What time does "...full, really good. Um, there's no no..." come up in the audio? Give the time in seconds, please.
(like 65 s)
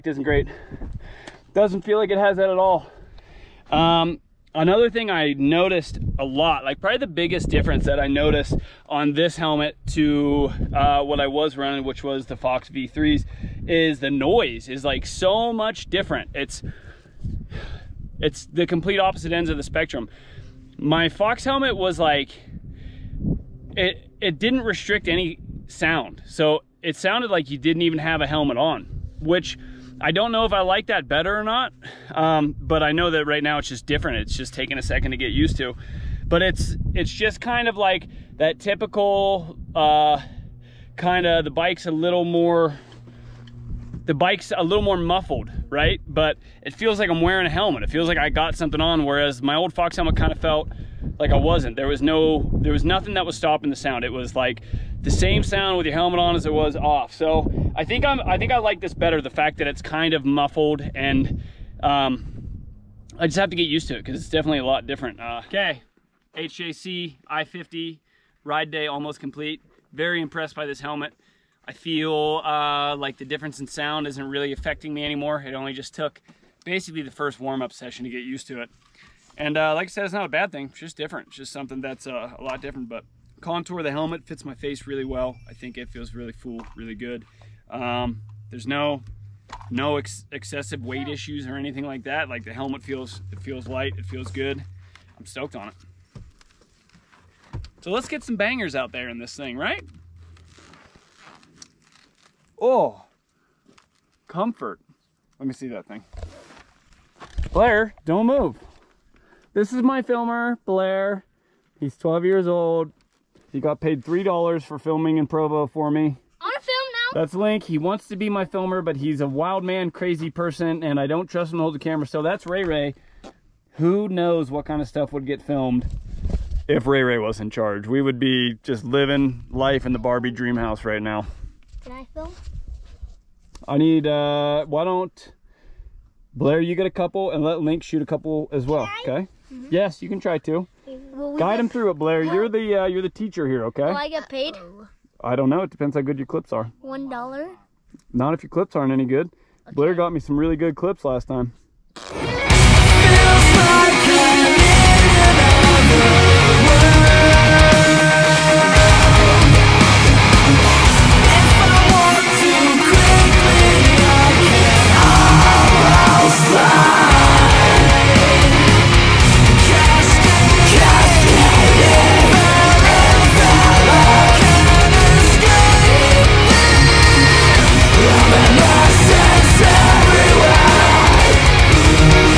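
86 s.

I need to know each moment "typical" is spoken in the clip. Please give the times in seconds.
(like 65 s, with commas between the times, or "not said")
38 s.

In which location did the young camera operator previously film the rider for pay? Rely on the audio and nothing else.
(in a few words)
Provo.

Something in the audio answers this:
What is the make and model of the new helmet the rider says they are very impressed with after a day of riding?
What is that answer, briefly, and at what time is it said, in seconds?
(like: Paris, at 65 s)
HJC I-50, at 66 s.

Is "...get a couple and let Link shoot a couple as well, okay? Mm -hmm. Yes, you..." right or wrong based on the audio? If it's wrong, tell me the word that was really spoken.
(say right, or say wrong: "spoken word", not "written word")
right.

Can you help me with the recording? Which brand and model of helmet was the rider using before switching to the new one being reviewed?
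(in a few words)
Fox V3.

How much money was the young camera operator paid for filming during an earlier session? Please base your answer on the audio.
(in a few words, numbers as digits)
$3.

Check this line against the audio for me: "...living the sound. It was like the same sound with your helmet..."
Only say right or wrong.
wrong.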